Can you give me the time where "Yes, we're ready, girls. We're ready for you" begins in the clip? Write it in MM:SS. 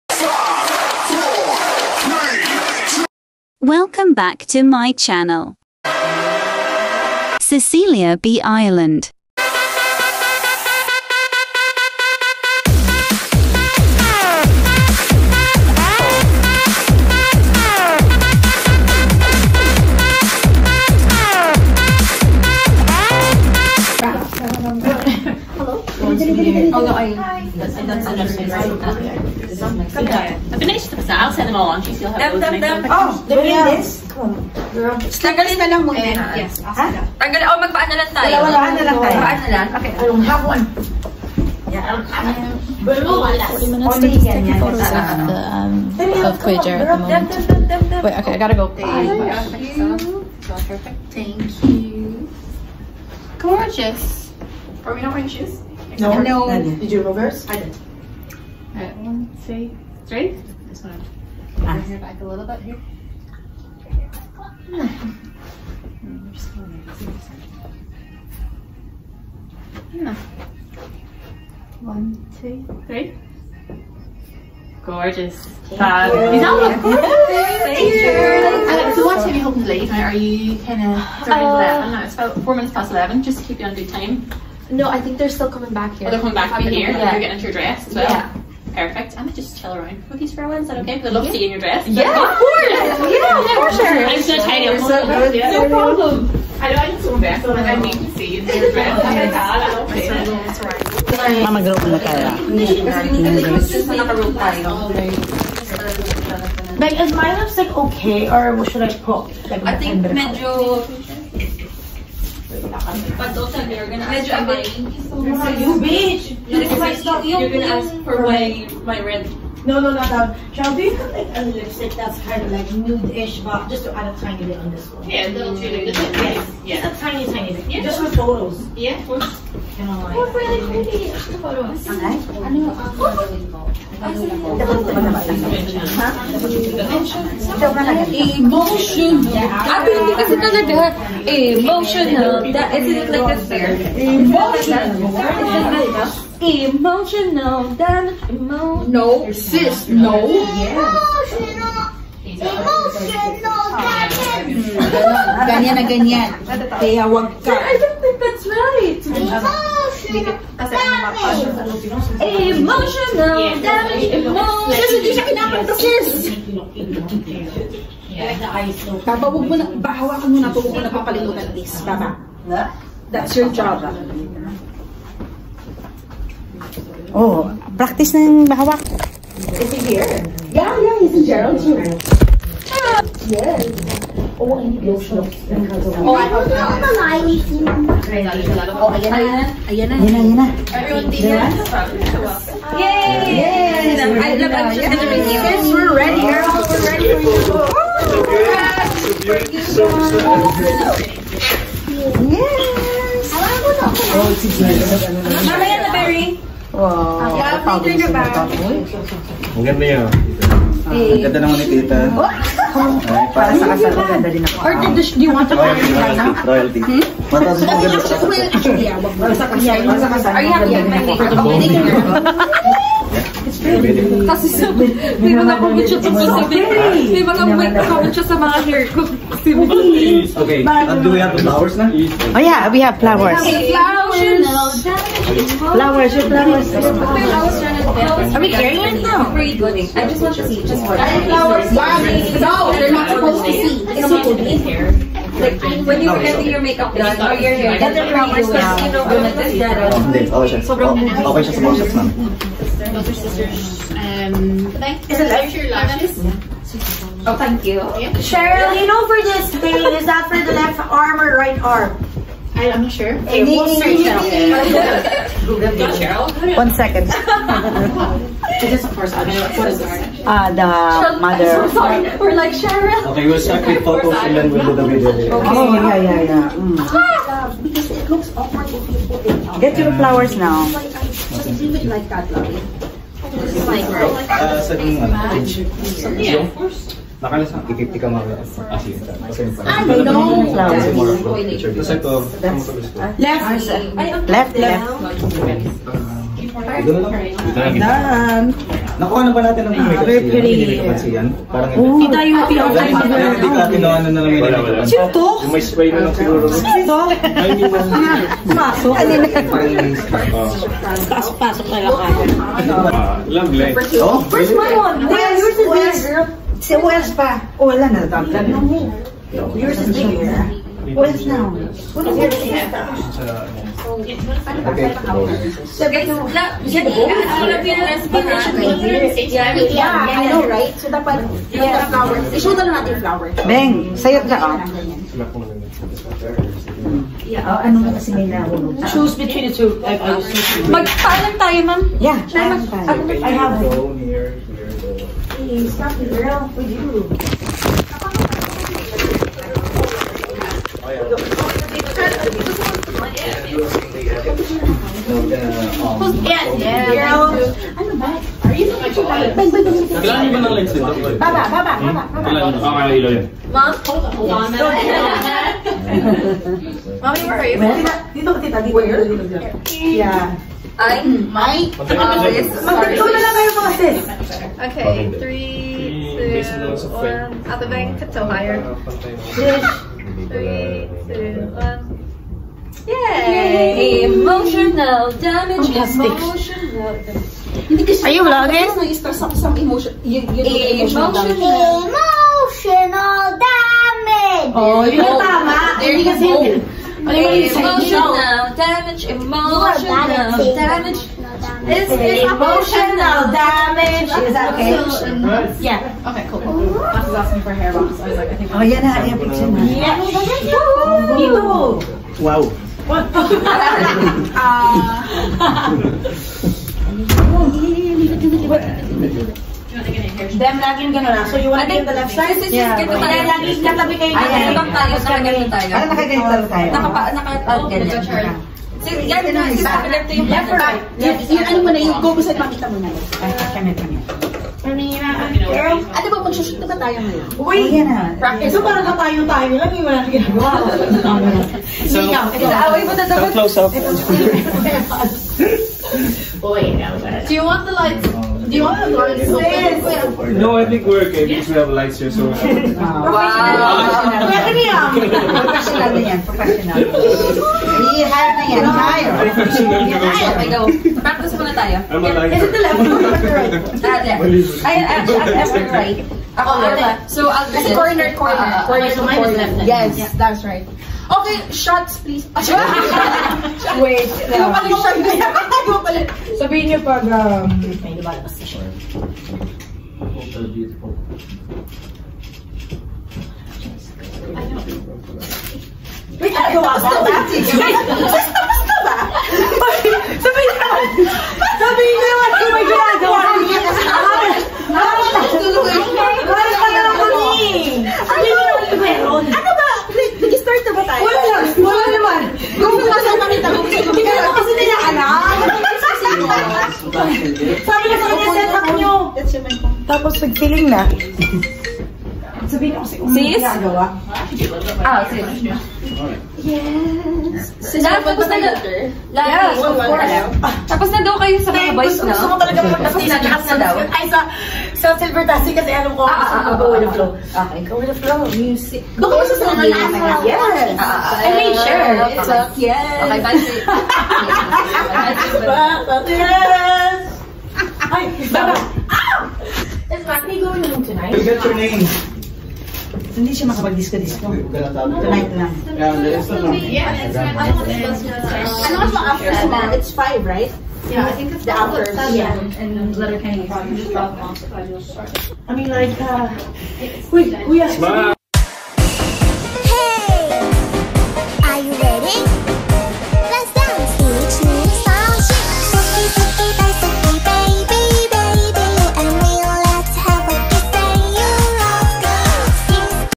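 03:15.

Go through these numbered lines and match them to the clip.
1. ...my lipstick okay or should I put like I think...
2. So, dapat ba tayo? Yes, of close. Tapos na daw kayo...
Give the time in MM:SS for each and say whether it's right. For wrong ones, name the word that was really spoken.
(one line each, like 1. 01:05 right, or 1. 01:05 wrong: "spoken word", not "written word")
1. 01:47 right
2. 08:37 wrong: "course", not "close".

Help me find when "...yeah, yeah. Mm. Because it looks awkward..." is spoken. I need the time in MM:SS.
04:35.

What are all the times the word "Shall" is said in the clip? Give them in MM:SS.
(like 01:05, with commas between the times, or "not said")
02:00.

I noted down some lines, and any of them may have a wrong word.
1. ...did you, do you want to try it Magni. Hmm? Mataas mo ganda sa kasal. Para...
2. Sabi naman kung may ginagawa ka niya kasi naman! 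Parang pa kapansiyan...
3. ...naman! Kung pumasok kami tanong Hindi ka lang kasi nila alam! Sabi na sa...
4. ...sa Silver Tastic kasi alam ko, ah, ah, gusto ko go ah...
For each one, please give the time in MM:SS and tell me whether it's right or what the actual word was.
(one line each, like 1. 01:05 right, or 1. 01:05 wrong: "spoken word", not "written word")
1. 03:34 wrong: "Royalty", not "Magni"
2. 08:11 wrong: "naman", not "kapansiyan"
3. 08:21 right
4. 08:44 right.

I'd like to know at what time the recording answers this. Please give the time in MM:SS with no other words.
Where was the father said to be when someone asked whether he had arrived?
03:01.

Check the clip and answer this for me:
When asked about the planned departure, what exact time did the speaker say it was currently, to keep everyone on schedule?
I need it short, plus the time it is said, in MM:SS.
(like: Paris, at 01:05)
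4 minutes past 11, at 01:22.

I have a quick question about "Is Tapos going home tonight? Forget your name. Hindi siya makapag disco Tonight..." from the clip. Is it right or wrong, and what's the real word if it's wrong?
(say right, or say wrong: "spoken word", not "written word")
wrong: "Magni", not "Tapos".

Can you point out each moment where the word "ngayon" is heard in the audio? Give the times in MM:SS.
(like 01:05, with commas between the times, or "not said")
07:17.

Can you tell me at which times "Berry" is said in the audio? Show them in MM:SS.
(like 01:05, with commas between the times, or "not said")
03:25.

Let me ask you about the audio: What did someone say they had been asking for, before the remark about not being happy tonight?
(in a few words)
hair wraps.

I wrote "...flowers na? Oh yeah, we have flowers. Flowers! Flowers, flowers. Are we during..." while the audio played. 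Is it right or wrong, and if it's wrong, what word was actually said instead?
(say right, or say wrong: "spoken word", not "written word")
wrong: "carrying", not "during".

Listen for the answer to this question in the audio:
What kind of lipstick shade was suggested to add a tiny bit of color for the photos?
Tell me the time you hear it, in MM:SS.
02:02.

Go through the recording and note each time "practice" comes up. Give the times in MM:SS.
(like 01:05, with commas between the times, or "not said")
02:57, 07:18, 07:41.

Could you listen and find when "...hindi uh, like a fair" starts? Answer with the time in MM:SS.
02:22.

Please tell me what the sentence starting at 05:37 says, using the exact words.
Yeah, oh, ano na kasi Choose between the two.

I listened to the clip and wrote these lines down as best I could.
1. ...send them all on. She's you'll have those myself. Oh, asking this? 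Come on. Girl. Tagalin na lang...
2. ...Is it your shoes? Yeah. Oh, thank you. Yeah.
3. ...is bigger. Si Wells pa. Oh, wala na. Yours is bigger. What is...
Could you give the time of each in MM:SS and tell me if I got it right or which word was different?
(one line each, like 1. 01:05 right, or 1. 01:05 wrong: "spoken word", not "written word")
1. 00:31 wrong: "during", not "asking"
2. 04:15 wrong: "lashes", not "shoes"
3. 05:15 right.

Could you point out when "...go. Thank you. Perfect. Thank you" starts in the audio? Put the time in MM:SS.
00:48.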